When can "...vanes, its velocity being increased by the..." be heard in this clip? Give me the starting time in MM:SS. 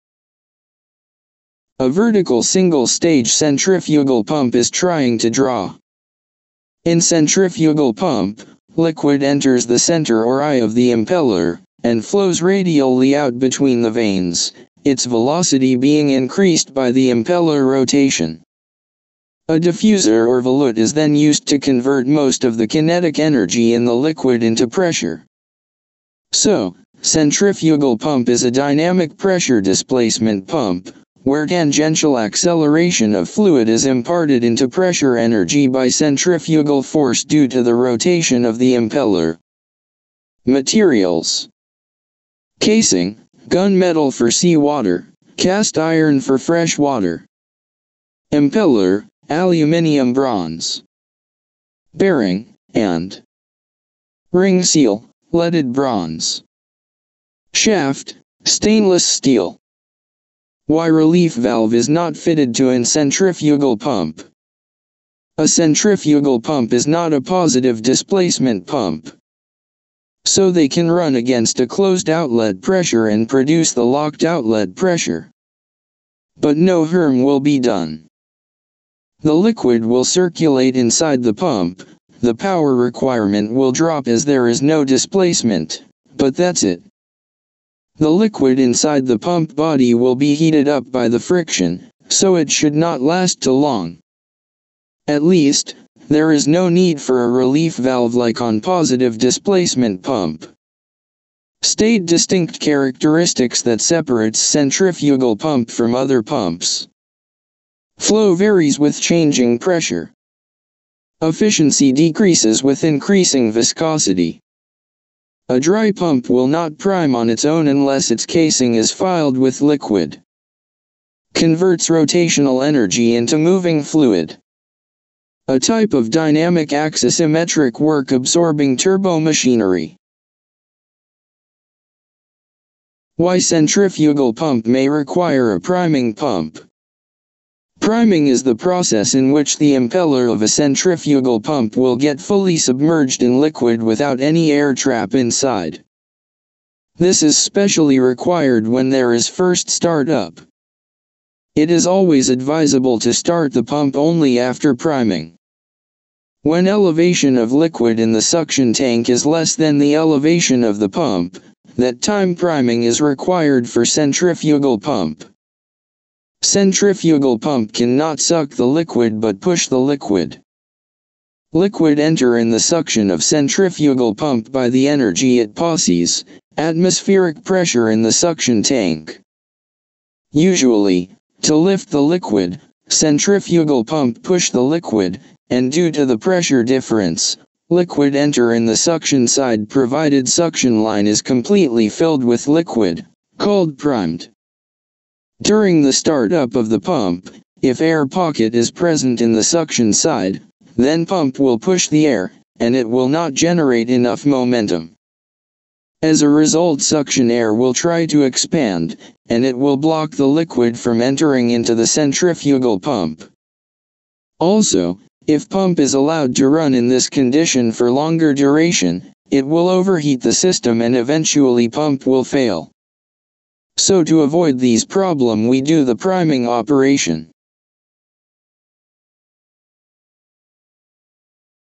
00:13.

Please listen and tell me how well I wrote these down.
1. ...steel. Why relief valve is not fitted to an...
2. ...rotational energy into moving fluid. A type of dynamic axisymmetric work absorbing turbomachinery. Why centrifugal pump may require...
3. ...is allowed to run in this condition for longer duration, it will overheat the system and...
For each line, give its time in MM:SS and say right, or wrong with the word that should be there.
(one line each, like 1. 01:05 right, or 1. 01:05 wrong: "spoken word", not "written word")
1. 00:59 right
2. 02:01 right
3. 03:35 right.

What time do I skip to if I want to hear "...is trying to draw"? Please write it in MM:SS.
00:04.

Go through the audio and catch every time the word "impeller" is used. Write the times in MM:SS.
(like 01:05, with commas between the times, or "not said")
00:10, 00:17, 00:38, 00:48, 02:19.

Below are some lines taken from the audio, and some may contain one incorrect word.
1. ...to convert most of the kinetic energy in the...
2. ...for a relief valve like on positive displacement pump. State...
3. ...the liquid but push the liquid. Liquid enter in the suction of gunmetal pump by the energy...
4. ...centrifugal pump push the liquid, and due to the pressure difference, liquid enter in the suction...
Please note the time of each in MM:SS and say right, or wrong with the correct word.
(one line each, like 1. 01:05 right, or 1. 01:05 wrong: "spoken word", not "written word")
1. 00:21 right
2. 01:37 right
3. 02:48 wrong: "centrifugal", not "gunmetal"
4. 03:02 right.